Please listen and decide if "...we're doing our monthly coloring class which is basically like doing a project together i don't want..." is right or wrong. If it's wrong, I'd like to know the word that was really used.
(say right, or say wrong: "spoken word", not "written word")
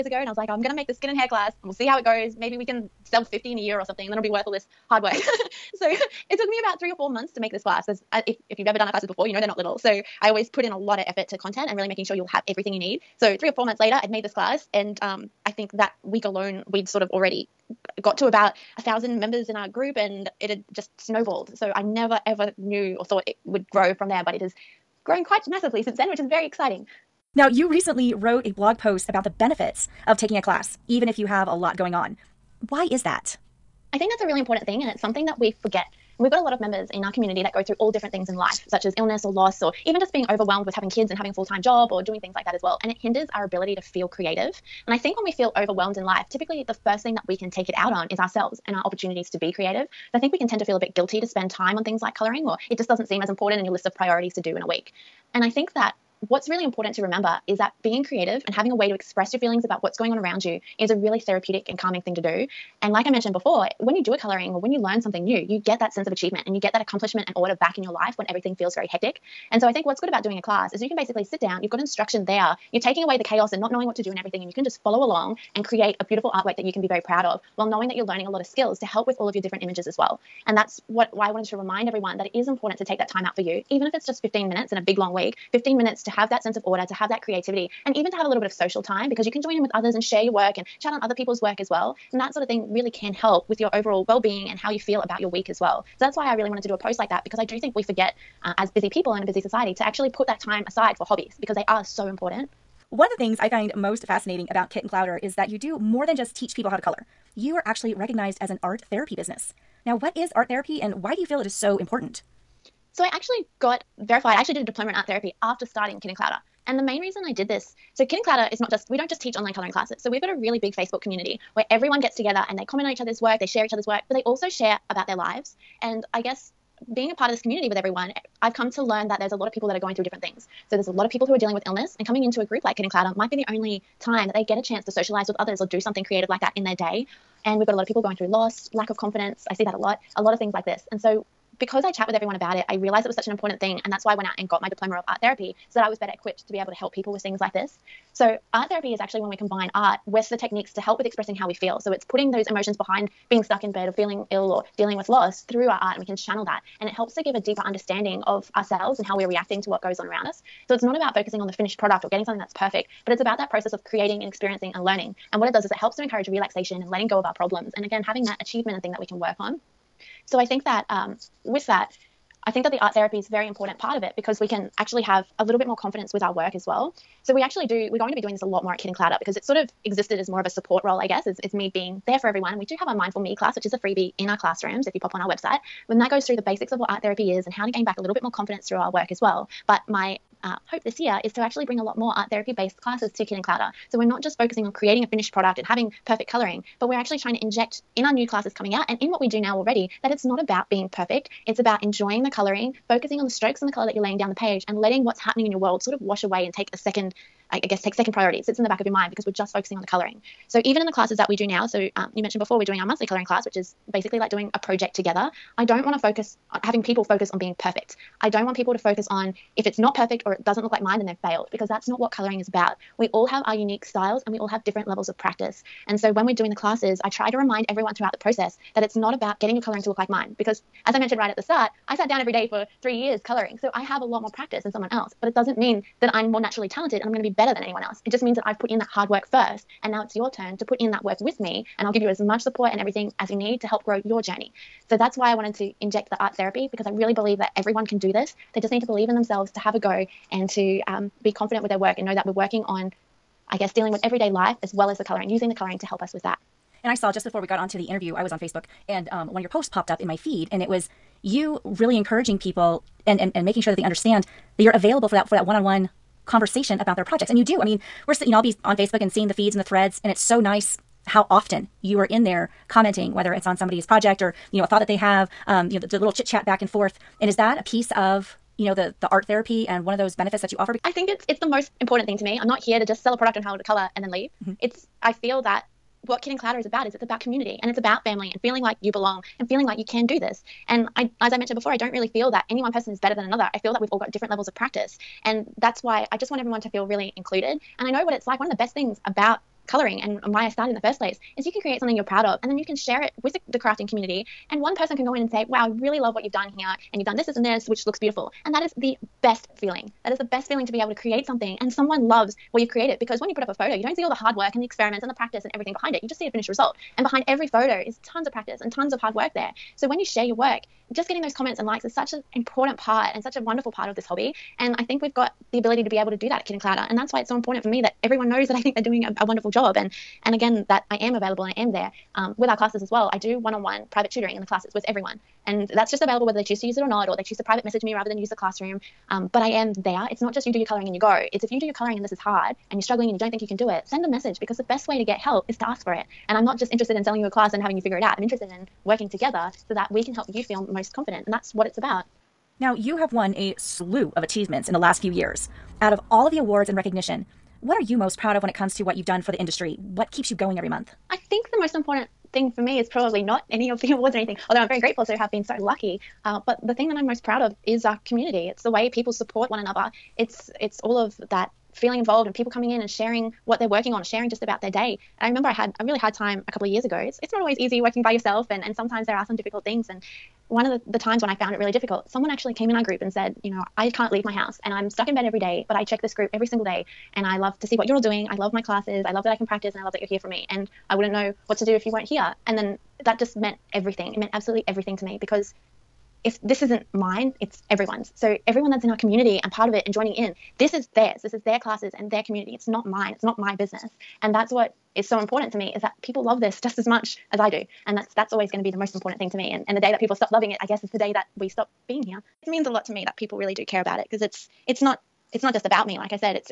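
right.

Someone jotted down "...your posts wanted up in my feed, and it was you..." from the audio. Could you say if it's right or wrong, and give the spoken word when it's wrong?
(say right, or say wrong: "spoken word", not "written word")
wrong: "popped", not "wanted".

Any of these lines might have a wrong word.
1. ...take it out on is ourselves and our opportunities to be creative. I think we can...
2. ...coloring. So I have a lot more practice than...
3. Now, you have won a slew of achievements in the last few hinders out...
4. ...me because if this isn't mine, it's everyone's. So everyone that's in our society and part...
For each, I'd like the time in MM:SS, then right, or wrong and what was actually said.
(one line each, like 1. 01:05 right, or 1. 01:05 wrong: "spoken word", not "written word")
1. 00:47 right
2. 03:53 right
3. 05:52 wrong: "years", not "hinders"
4. 06:35 wrong: "community", not "society".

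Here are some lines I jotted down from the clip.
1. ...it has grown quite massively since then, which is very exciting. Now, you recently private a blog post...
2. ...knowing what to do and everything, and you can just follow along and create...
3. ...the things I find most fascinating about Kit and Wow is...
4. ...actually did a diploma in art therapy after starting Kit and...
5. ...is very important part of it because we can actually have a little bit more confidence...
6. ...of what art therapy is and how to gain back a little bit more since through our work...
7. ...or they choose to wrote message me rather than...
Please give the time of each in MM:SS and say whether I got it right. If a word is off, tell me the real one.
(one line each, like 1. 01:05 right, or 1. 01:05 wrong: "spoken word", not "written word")
1. 00:24 wrong: "wrote", not "private"
2. 01:13 right
3. 01:43 wrong: "Clowder", not "Wow"
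4. 01:54 right
5. 02:53 right
6. 03:06 wrong: "confidence", not "since"
7. 05:37 wrong: "private", not "wrote".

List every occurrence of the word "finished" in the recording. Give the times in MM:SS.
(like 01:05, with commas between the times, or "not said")
02:41, 03:15, 05:16.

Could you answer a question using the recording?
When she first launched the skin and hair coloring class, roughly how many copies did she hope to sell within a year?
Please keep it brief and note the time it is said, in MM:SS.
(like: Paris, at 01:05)
50, at 00:03.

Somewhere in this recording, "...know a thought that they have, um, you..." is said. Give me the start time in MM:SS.
04:34.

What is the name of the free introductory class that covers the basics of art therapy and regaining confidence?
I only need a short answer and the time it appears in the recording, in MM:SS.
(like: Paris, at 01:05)
Mindful Me, at 03:02.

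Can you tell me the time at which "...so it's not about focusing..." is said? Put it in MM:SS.
02:40.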